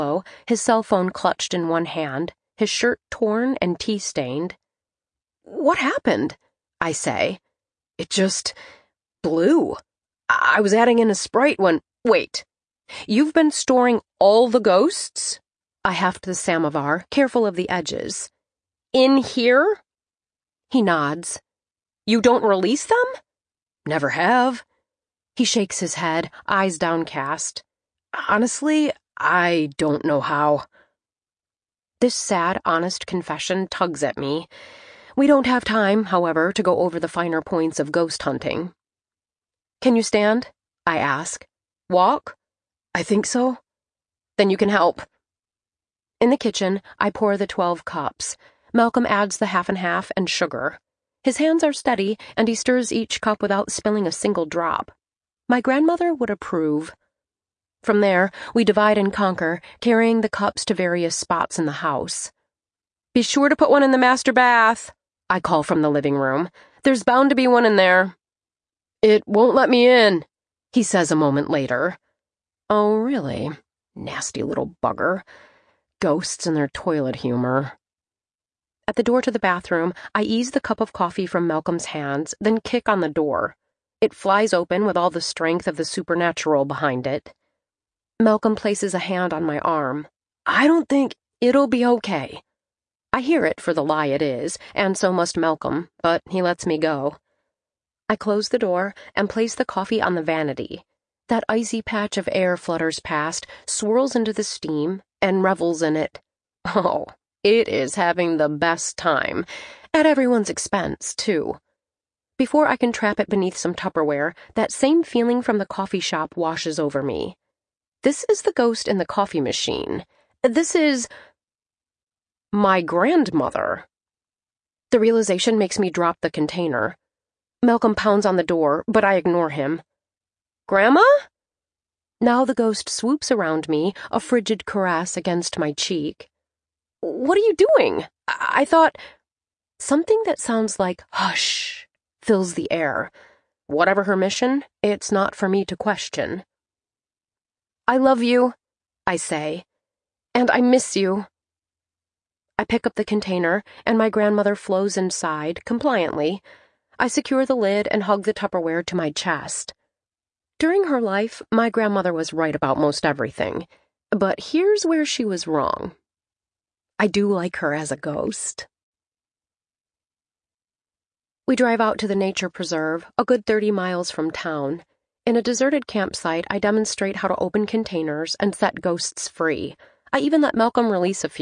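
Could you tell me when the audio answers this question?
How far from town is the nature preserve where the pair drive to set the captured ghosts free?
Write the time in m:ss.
2:53.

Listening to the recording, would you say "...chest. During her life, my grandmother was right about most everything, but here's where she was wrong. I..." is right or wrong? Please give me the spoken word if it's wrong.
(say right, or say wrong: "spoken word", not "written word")
right.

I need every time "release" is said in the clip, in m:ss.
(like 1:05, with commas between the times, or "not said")
0:22, 3:00.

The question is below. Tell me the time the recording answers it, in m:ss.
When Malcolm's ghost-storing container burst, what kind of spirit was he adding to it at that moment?
0:11.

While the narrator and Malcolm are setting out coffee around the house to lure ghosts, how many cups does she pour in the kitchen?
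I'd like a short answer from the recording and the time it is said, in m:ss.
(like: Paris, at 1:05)
12, at 0:47.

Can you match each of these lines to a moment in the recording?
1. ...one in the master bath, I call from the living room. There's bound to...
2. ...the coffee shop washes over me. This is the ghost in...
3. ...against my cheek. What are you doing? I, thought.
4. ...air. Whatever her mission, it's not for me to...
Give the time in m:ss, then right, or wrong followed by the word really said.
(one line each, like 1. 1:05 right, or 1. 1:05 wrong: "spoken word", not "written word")
1. 1:03 right
2. 1:55 right
3. 2:15 right
4. 2:22 right.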